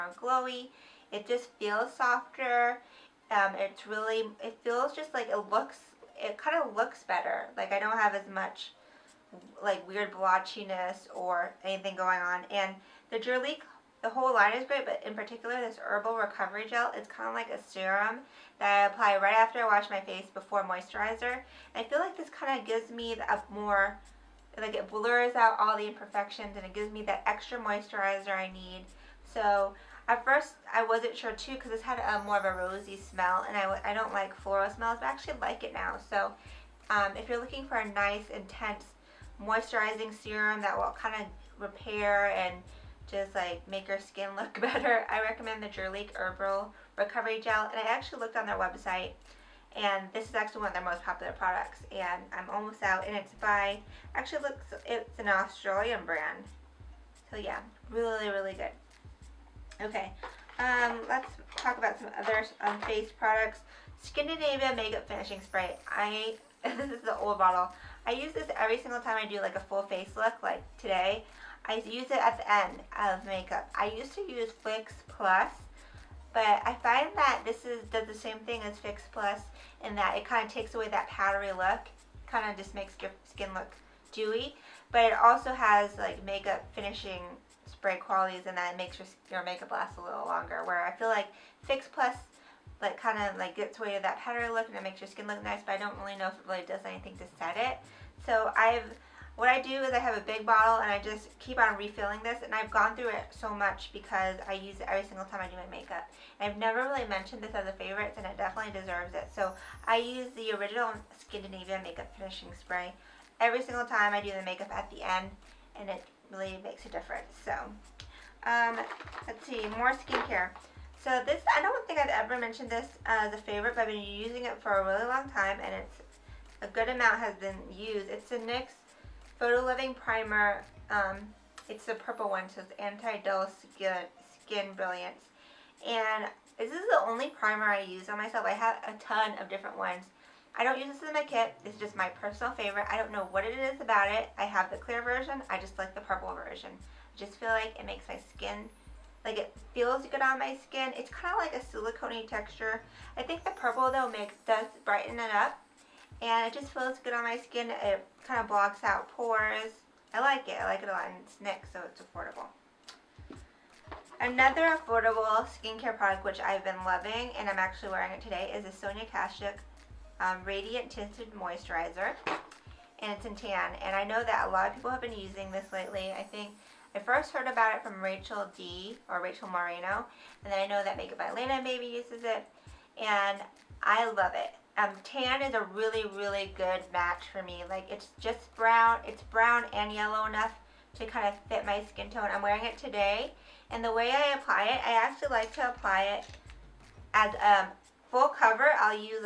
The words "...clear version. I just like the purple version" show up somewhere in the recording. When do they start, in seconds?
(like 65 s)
144 s.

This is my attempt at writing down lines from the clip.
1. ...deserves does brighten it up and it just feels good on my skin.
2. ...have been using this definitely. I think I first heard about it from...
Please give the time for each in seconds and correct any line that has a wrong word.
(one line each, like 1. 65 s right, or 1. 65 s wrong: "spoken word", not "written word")
1. 154 s wrong: "makes", not "deserves"
2. 174 s wrong: "lately", not "definitely".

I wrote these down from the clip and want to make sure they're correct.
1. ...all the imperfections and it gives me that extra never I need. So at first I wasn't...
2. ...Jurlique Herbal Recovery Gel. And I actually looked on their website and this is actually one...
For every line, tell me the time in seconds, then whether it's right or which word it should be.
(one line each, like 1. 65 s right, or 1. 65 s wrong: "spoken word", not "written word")
1. 25 s wrong: "moisturizer", not "never"
2. 45 s right.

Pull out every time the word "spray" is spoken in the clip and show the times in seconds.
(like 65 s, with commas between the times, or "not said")
65 s, 87 s, 112 s.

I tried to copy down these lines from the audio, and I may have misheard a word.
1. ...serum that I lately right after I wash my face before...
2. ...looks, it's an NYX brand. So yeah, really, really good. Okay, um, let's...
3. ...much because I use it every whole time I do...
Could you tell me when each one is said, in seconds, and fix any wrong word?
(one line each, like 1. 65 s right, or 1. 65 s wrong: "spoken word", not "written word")
1. 17 s wrong: "apply", not "lately"
2. 54 s wrong: "Australian", not "NYX"
3. 103 s wrong: "single", not "whole".